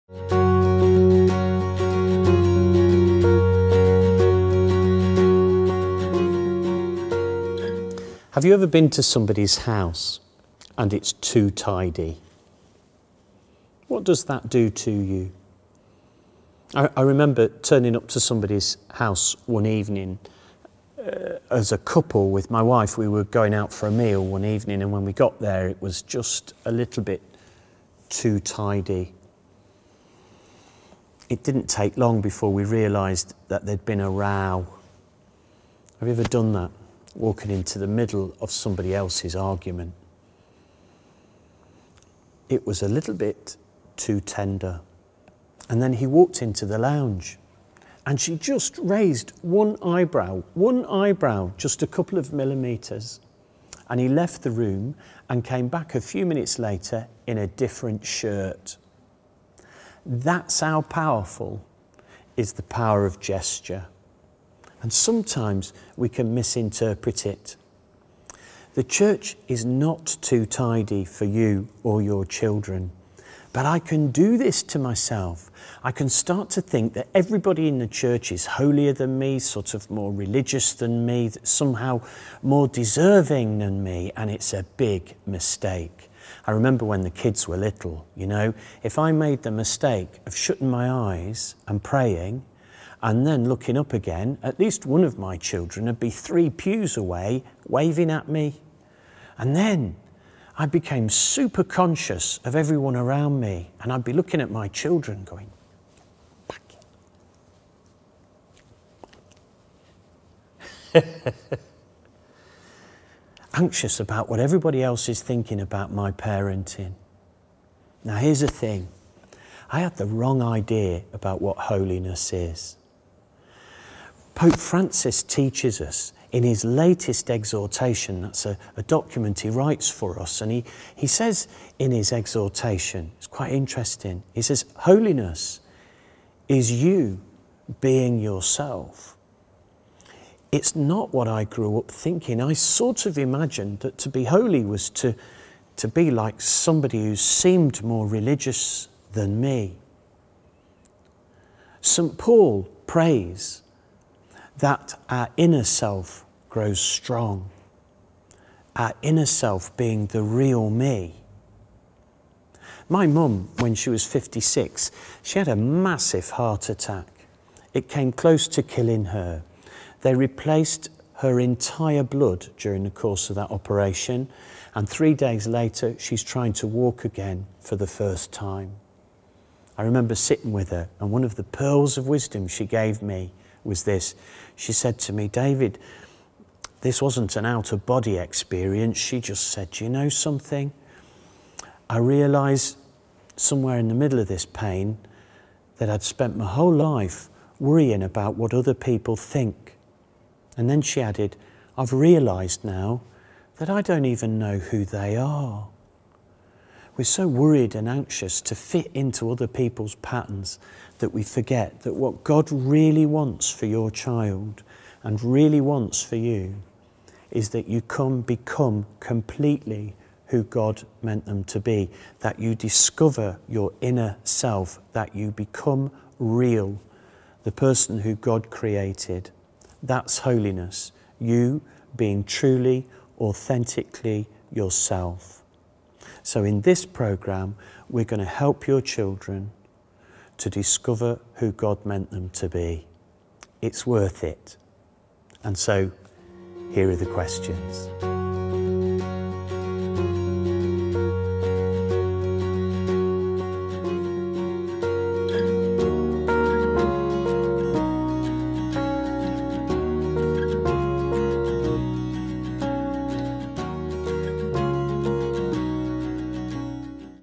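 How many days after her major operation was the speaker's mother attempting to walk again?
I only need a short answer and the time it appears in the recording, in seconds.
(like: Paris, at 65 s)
3, at 174 s.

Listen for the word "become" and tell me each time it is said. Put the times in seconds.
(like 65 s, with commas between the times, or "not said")
218 s, 225 s.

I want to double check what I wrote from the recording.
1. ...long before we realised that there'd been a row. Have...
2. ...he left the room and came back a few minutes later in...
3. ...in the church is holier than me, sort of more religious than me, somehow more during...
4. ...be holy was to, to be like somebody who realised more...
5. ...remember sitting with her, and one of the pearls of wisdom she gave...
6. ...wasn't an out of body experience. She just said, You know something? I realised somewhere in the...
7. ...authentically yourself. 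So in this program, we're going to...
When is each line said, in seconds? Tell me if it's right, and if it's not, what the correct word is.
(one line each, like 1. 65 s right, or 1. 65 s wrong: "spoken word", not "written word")
1. 31 s right
2. 53 s right
3. 77 s wrong: "deserving", not "during"
4. 144 s wrong: "seemed", not "realised"
5. 179 s right
6. 187 s right
7. 233 s right.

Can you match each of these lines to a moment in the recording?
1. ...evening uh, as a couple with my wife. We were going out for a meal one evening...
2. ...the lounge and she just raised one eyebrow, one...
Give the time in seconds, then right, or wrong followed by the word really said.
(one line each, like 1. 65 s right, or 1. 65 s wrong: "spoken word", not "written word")
1. 19 s right
2. 46 s right.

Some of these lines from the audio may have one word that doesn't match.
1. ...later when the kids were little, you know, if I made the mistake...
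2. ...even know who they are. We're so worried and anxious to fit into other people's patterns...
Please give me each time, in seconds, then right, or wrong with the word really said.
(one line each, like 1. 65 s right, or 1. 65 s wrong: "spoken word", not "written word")
1. 86 s wrong: "remember", not "later"
2. 204 s right.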